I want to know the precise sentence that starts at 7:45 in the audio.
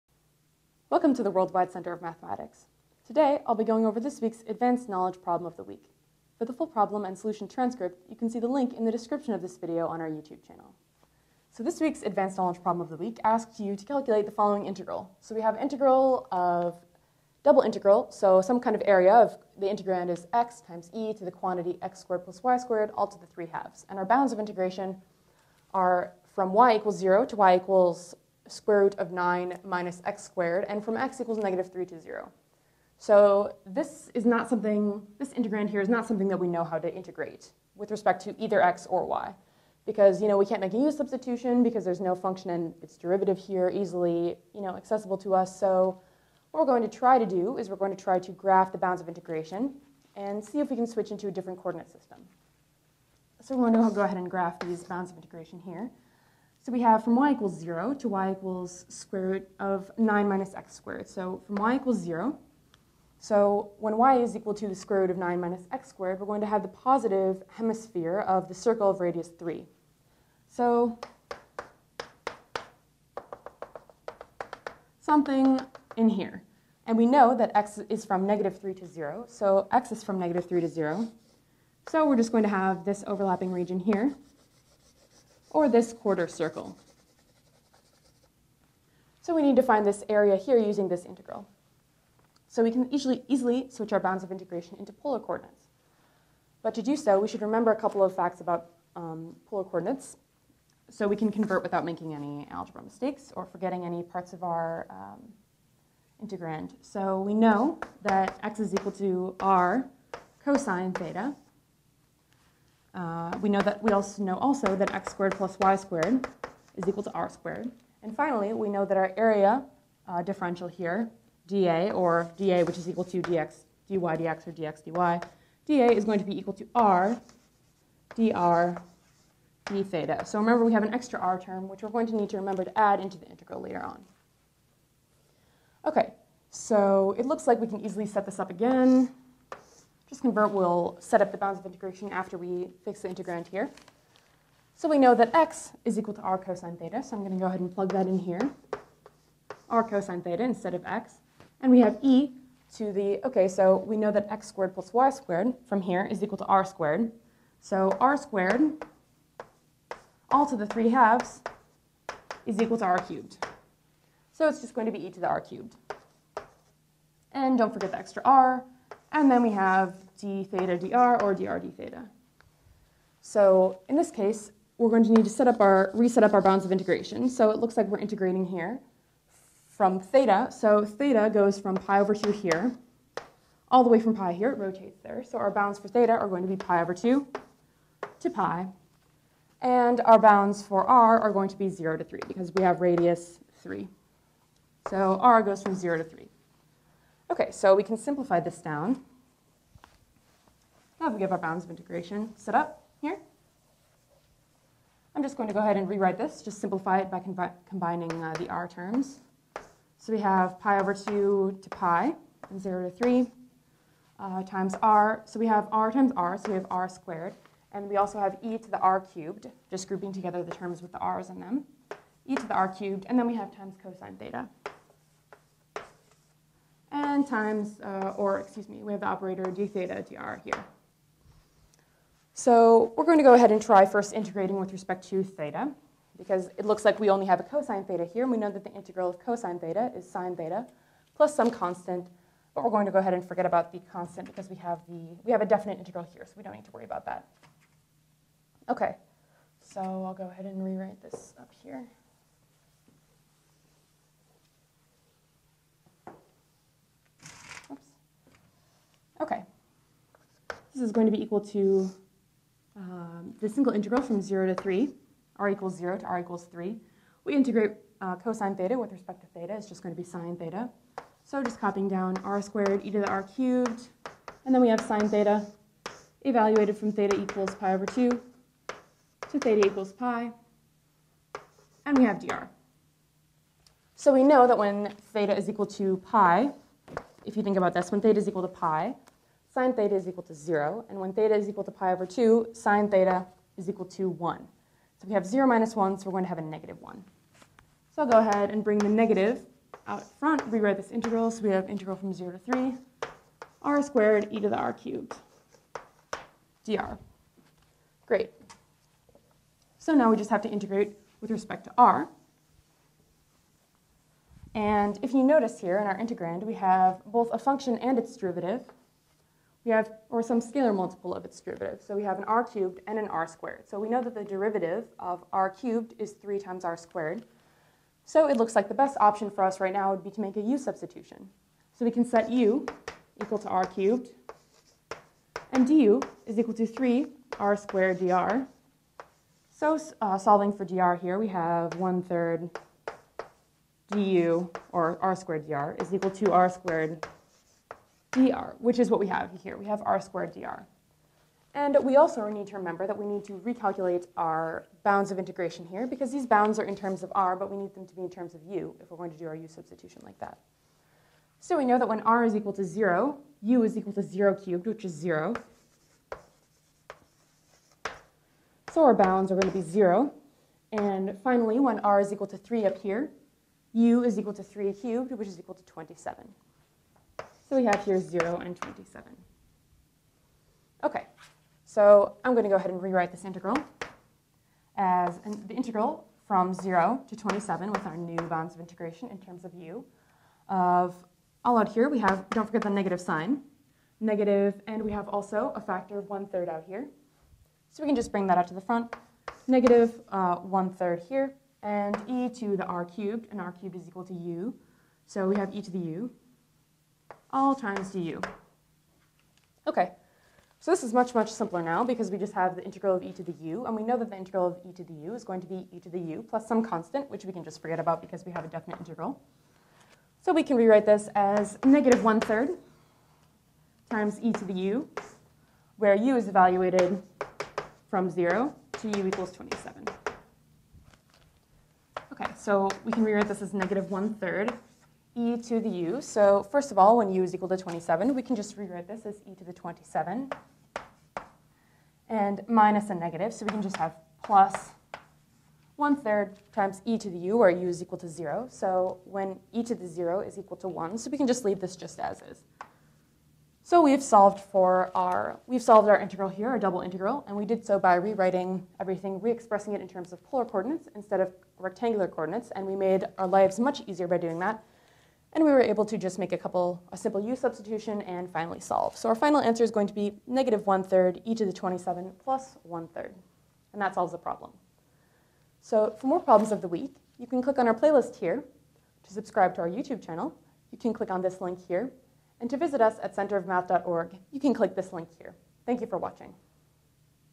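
And we were able to just make a couple, a simple u substitution and finally solve.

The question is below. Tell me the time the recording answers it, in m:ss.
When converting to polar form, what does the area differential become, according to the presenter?
2:06.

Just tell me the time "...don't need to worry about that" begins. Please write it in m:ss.
4:06.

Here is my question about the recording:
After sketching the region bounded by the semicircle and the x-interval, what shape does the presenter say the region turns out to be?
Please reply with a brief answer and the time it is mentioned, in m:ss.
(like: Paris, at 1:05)
quarter circle, at 1:25.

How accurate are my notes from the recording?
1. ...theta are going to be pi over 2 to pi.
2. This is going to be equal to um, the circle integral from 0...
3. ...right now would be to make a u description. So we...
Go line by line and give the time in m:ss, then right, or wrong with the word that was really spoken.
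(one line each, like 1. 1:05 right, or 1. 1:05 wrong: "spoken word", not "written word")
1. 3:05 right
2. 4:20 wrong: "single", not "circle"
3. 5:29 wrong: "substitution", not "description".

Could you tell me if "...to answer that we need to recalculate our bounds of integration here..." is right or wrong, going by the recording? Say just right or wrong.
wrong.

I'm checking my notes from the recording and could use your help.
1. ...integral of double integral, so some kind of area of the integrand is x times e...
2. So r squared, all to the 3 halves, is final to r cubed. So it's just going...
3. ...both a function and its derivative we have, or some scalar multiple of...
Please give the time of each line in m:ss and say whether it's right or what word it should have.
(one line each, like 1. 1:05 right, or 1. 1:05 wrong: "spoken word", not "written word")
1. 0:15 right
2. 2:37 wrong: "equal", not "final"
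3. 5:17 right.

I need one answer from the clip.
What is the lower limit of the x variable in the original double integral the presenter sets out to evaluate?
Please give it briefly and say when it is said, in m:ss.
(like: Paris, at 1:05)
-3, at 0:30.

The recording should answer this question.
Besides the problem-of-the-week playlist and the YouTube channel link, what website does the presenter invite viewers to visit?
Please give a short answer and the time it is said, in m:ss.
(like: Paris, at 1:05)
centerofmath.org, at 8:03.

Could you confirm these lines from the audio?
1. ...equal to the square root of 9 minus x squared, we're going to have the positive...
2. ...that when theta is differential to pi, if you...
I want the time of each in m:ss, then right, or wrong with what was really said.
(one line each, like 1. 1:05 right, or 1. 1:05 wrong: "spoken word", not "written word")
1. 1:04 right
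2. 4:44 wrong: "equal", not "differential".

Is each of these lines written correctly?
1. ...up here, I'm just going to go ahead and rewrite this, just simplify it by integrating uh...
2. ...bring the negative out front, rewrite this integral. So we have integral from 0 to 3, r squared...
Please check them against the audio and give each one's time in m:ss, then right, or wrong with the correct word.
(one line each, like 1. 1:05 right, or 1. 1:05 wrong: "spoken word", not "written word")
1. 3:22 wrong: "combining", not "integrating"
2. 4:58 right.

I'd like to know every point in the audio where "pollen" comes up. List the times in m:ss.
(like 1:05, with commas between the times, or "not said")
not said.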